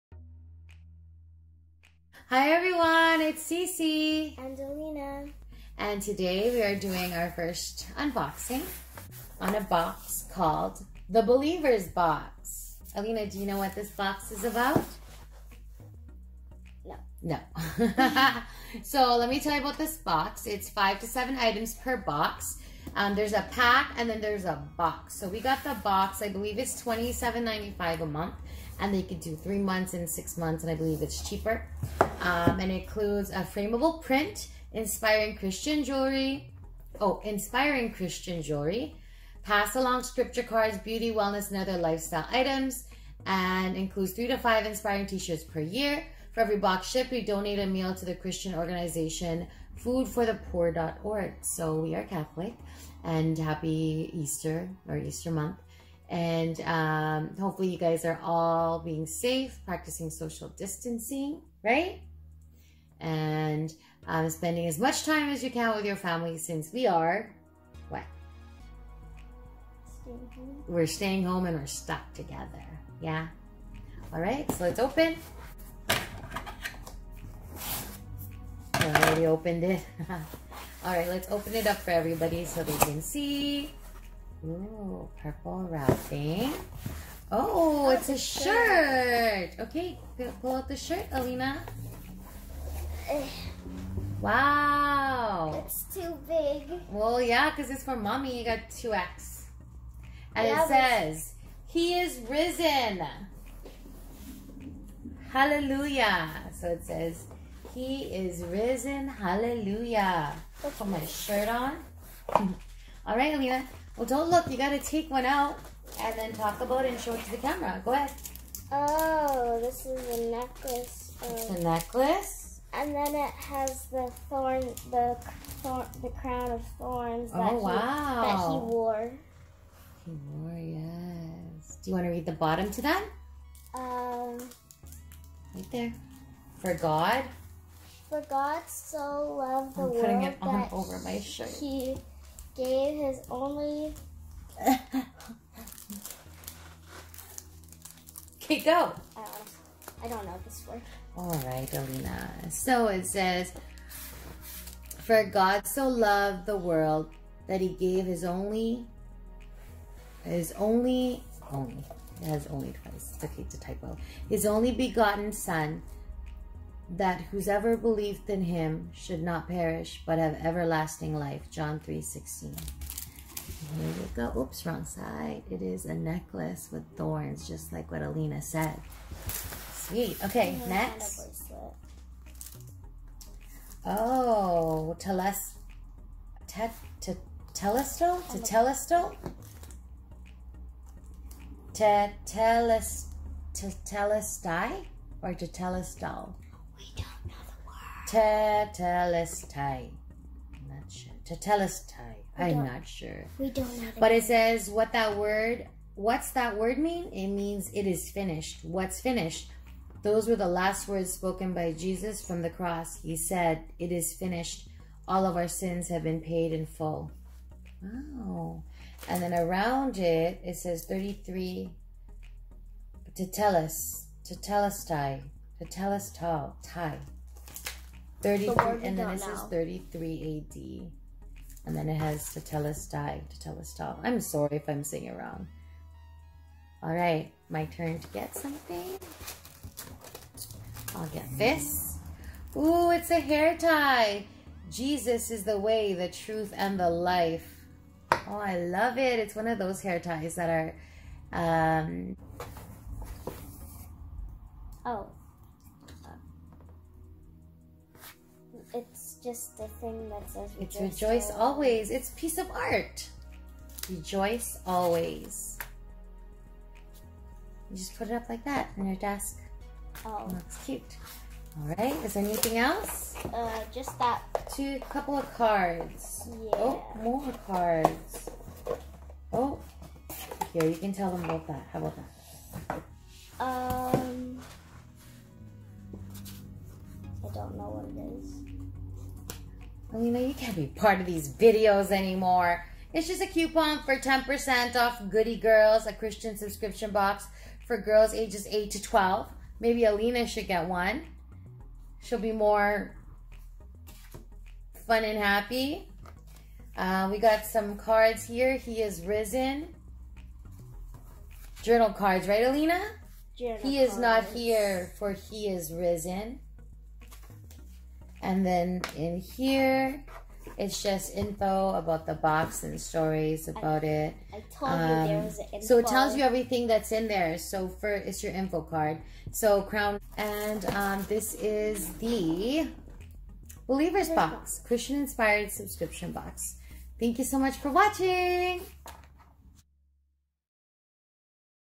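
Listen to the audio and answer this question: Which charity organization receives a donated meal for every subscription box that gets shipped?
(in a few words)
foodforthepoor.org.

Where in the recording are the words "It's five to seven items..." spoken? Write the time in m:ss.
0:20.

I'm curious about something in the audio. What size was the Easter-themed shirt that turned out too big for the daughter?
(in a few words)
2X.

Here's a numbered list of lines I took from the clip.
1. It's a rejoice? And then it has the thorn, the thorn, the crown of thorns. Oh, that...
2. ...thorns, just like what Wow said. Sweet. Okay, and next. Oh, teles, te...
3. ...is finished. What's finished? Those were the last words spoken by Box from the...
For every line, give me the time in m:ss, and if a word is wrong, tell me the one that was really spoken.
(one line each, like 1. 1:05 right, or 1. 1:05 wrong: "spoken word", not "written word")
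1. 2:01 wrong: "necklace", not "rejoice"
2. 2:56 wrong: "Alina", not "Wow"
3. 3:27 wrong: "Jesus", not "Box".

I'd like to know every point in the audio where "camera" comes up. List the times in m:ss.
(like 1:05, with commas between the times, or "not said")
1:57.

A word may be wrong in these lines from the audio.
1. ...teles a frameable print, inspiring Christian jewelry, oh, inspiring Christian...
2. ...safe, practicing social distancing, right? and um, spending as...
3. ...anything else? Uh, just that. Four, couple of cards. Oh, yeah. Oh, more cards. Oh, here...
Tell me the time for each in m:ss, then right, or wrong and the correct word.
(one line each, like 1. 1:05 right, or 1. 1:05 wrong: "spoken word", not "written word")
1. 0:32 wrong: "includes", not "teles"
2. 0:59 right
3. 4:32 wrong: "Two", not "Four".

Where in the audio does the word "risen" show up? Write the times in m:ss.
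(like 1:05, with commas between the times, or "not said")
1:42, 1:48, 5:09, 5:15.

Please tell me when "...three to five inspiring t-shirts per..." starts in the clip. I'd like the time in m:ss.
0:44.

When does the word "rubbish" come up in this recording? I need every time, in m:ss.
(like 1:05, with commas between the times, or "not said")
not said.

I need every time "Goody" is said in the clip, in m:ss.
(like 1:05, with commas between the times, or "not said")
4:55.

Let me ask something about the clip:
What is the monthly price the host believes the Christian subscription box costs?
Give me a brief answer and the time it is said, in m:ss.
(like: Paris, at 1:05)
$27.95, at 0:26.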